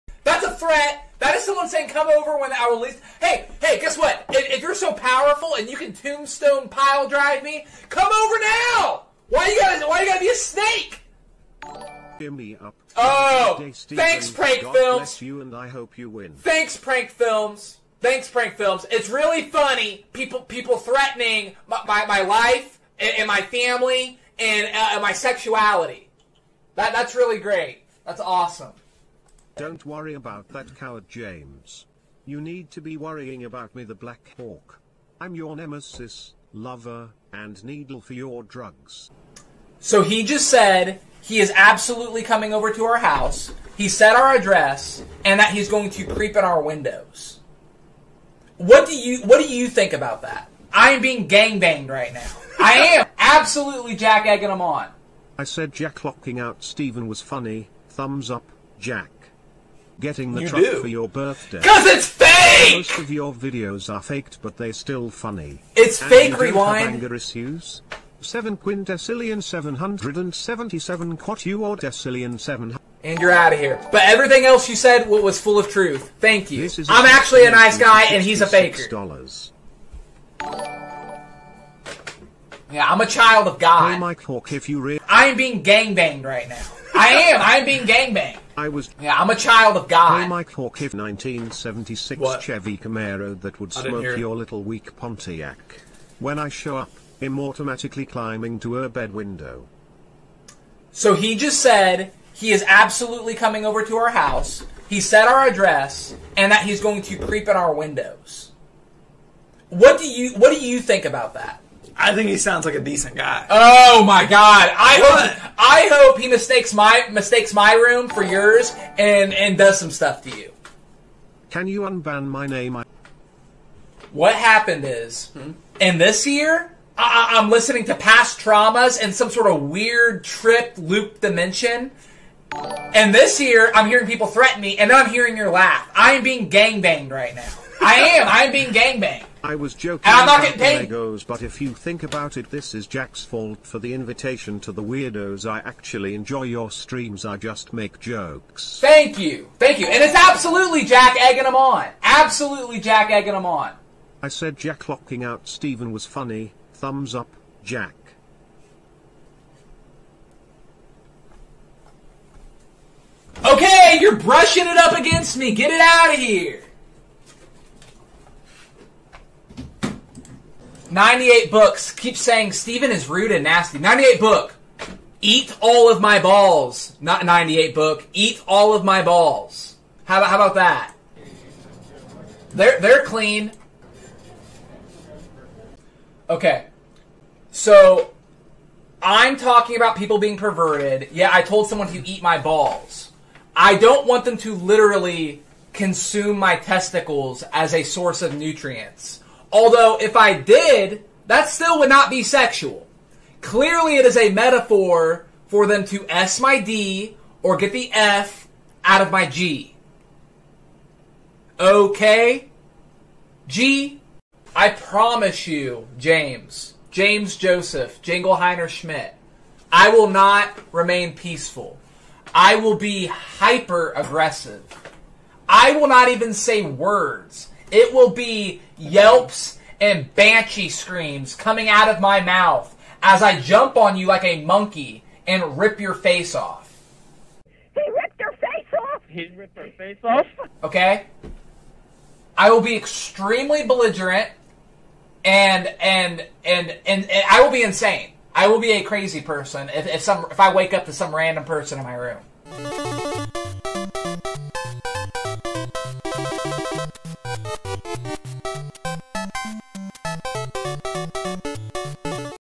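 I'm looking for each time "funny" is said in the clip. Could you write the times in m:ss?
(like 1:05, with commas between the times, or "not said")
0:19, 0:57, 1:05, 2:36.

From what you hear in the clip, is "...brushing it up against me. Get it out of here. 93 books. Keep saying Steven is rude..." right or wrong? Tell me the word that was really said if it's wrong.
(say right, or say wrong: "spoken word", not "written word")
wrong: "98", not "93".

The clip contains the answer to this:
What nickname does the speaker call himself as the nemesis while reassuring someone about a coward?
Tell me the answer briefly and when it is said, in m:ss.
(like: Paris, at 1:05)
Black Hawk, at 0:33.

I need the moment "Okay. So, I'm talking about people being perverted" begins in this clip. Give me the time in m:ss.
3:06.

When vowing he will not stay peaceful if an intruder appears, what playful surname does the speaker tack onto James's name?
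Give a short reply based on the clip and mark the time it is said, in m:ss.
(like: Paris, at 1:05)
Jingleheimer Schmidt, at 3:38.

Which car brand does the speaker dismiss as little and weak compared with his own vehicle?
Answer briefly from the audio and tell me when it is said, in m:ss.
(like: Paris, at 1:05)
Pontiac, at 1:34.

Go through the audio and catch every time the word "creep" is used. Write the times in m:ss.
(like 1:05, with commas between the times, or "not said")
0:46, 1:47.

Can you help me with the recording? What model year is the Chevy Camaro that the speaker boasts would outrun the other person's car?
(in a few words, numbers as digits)
1976.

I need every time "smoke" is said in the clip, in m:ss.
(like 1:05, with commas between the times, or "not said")
1:33.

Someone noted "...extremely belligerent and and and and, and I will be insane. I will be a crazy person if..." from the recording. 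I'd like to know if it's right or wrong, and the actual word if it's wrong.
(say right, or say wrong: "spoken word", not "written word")
right.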